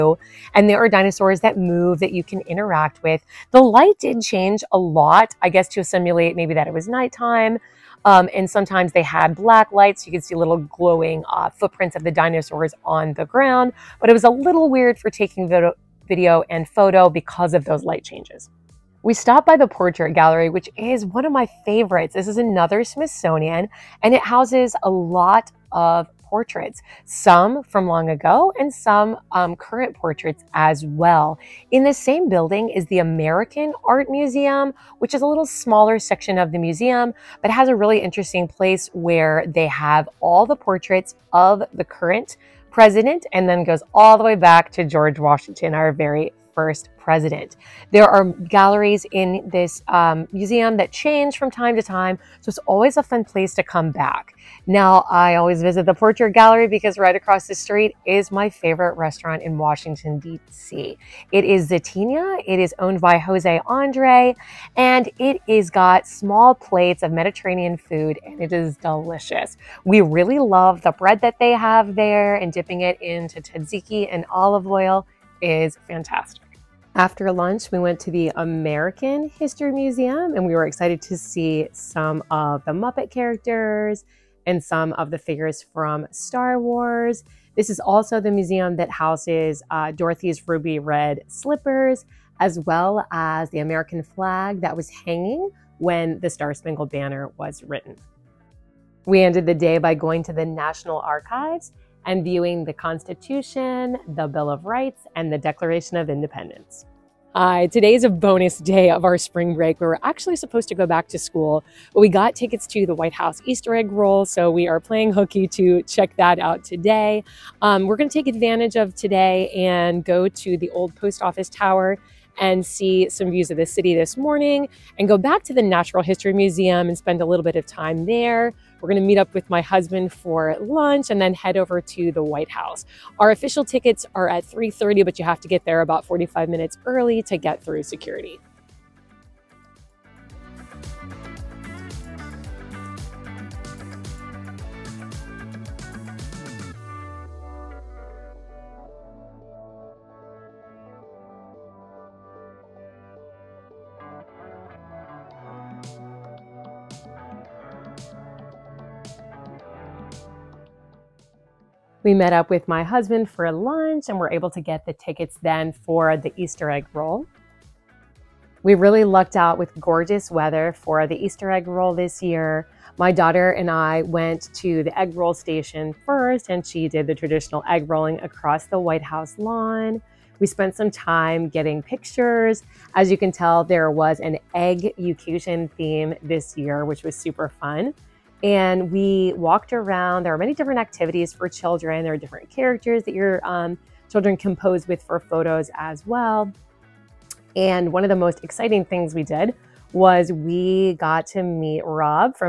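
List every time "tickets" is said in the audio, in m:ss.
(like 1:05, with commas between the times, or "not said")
1:52, 2:13, 2:44.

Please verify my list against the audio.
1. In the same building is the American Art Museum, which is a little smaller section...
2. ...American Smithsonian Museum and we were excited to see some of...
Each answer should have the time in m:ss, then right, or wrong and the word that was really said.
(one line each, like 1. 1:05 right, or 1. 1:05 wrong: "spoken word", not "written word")
1. 0:31 right
2. 1:18 wrong: "History", not "Smithsonian".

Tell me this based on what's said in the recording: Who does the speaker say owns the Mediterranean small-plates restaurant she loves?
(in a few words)
Jose Andre.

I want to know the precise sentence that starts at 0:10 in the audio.
So you could see little glowing uh, footprints of the dinosaurs on the ground.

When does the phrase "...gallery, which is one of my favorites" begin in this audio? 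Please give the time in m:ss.
0:20.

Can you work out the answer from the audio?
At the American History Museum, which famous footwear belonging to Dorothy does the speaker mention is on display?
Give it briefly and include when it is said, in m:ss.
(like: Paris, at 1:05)
ruby red slippers, at 1:30.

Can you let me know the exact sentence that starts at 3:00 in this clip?
We spent some time getting pictures.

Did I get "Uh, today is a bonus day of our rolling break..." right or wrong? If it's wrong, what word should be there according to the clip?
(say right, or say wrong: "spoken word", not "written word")
wrong: "spring", not "rolling".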